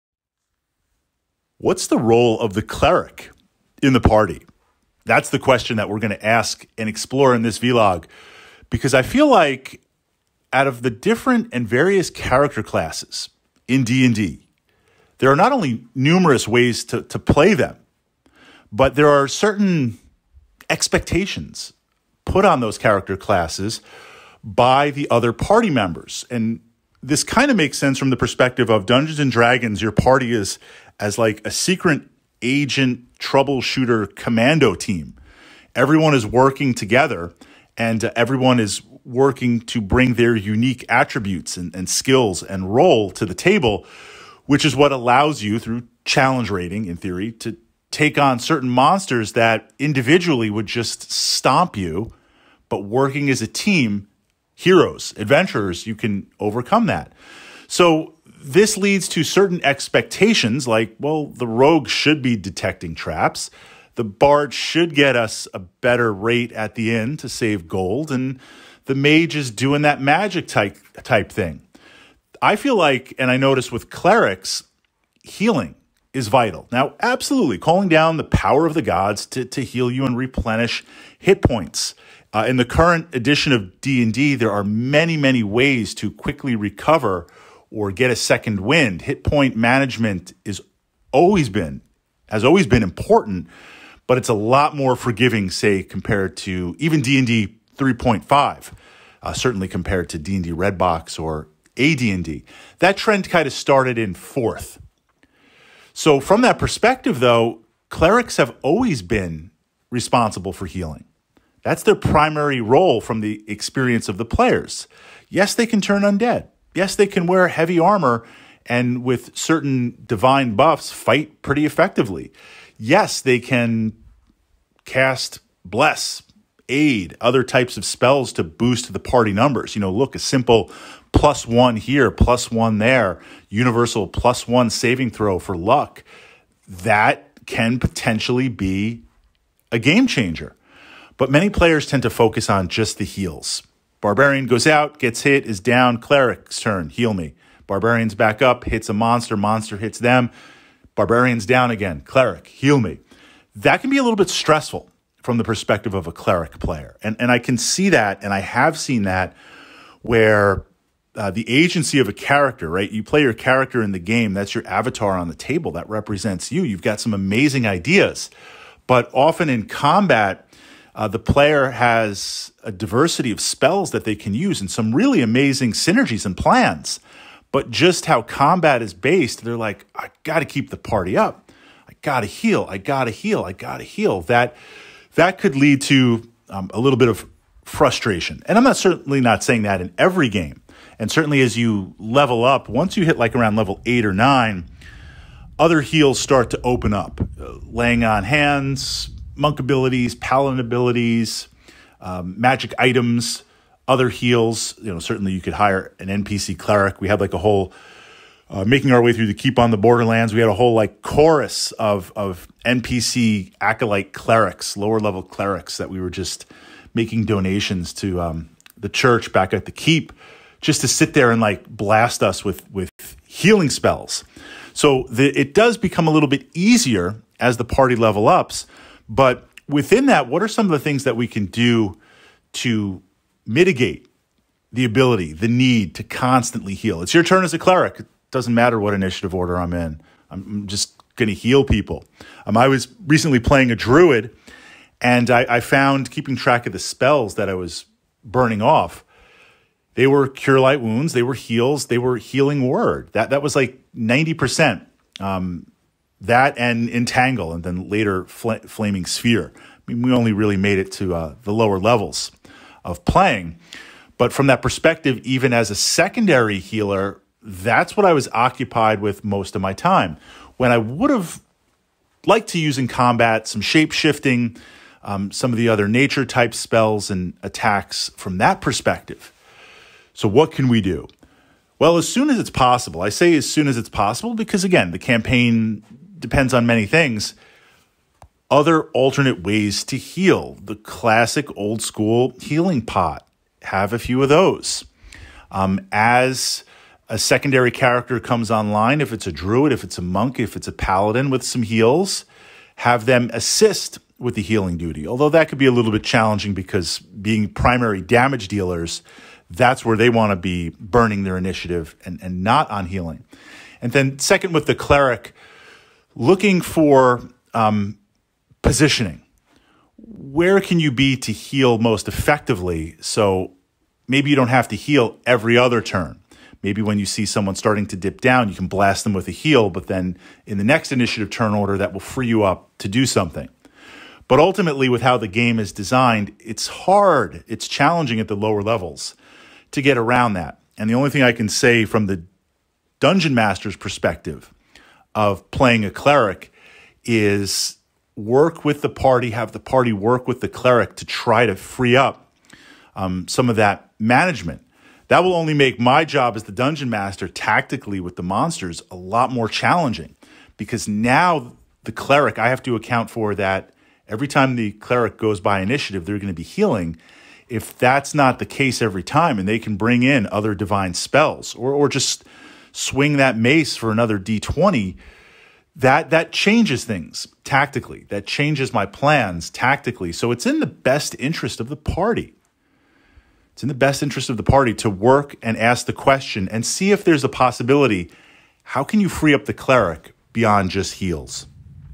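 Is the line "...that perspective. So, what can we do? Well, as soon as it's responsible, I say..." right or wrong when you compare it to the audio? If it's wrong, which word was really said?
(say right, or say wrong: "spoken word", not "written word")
wrong: "possible", not "responsible".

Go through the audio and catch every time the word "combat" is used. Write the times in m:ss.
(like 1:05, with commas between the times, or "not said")
2:49, 2:58, 4:32.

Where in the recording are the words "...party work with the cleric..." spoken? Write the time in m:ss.
5:49.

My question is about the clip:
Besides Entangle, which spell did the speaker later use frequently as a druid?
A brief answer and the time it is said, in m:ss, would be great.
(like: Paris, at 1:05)
Flaming Sphere, at 4:18.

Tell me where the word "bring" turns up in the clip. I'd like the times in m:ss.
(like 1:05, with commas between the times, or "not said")
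0:39, 6:09.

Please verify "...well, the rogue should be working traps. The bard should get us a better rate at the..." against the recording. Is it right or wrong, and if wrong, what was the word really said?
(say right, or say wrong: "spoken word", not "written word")
wrong: "detecting", not "working".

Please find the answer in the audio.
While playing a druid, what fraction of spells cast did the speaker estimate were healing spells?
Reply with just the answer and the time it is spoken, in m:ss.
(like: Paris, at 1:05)
90 percent, at 4:13.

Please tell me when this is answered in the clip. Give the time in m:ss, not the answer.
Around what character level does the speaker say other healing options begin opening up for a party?
3:13.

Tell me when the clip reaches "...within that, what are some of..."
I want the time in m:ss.
3:49.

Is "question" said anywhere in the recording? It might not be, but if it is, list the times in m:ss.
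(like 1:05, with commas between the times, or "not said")
0:05, 6:25.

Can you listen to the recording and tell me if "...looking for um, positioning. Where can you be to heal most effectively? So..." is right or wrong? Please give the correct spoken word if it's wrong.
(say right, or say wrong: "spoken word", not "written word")
right.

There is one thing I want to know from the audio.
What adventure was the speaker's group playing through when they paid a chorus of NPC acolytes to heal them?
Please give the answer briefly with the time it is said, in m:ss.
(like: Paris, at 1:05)
Keep on the Borderlands, at 3:29.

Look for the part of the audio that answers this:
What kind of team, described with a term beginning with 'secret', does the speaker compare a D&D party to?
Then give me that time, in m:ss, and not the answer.
0:31.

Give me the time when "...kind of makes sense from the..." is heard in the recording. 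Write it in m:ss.
0:27.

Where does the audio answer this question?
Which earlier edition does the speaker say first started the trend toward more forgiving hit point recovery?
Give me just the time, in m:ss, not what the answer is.
1:44.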